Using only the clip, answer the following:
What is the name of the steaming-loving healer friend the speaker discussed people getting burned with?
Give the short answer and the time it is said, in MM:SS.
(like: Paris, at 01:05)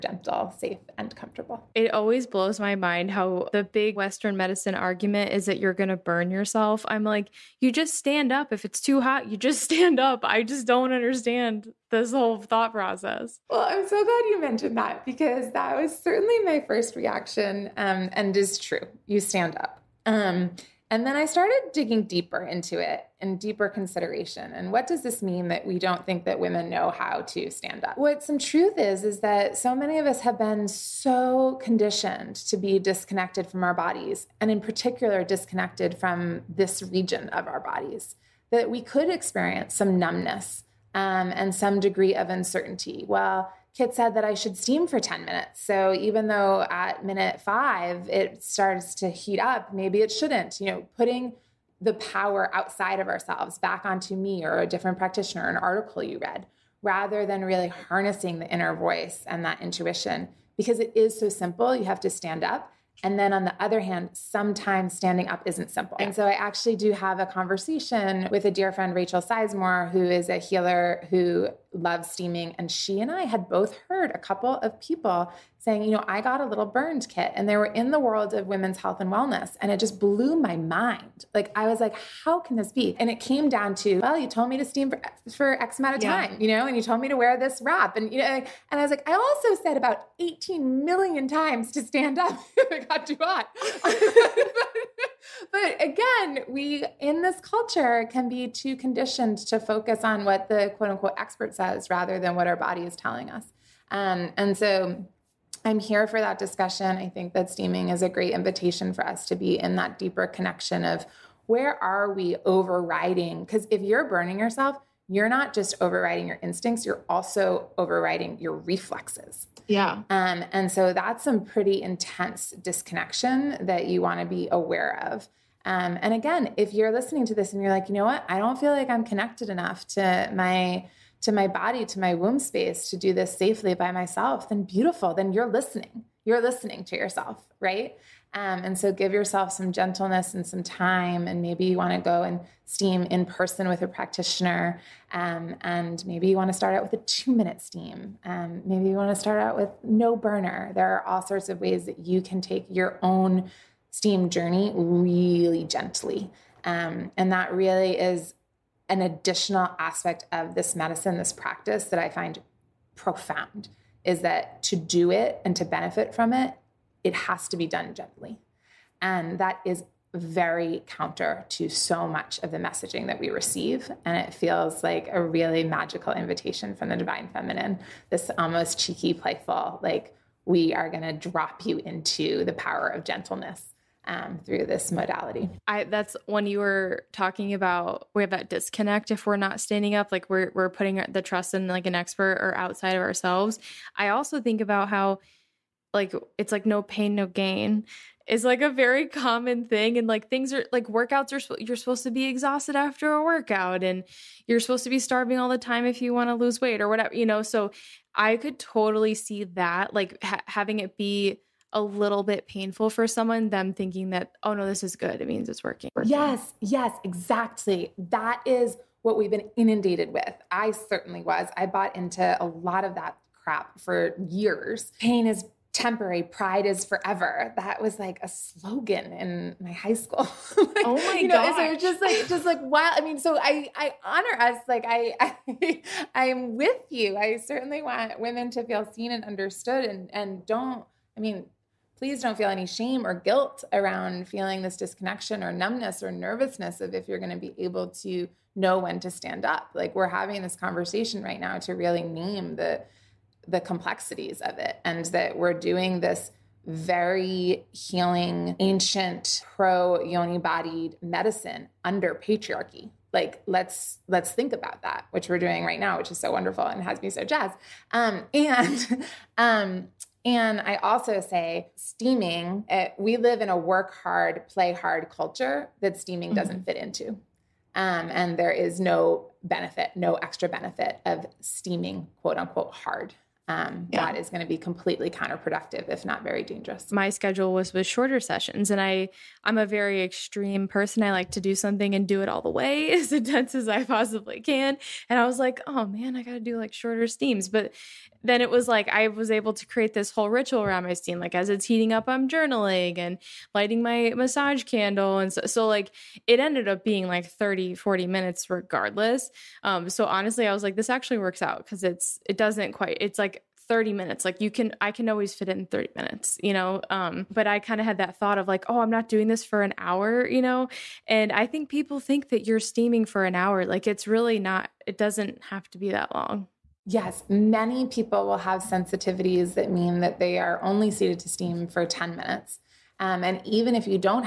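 Rachel Sizemore, at 01:08.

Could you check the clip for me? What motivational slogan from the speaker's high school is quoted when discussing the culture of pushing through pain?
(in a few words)
Pain is temporary, pride is forever.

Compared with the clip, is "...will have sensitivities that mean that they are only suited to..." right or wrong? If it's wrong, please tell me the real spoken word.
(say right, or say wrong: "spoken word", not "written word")
right.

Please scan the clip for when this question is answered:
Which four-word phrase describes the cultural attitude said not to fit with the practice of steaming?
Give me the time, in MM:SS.
04:33.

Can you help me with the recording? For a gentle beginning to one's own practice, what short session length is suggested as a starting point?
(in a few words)
2 minutes.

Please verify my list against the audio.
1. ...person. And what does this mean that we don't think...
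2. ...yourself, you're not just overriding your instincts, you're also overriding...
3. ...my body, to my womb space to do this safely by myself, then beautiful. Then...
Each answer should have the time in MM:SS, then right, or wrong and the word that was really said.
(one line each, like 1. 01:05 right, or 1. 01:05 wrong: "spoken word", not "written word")
1. 00:23 wrong: "consideration", not "person"
2. 01:54 right
3. 02:11 right.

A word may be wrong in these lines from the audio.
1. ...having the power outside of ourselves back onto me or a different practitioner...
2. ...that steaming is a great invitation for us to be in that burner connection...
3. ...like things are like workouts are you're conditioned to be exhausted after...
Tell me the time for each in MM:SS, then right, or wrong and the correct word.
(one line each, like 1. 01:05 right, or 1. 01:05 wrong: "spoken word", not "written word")
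1. 00:50 wrong: "putting", not "having"
2. 01:47 wrong: "deeper", not "burner"
3. 03:20 wrong: "supposed", not "conditioned".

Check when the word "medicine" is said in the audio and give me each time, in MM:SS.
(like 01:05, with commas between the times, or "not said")
00:04, 02:40, 04:21.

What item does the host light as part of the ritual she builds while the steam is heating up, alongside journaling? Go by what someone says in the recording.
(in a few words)
massage candle.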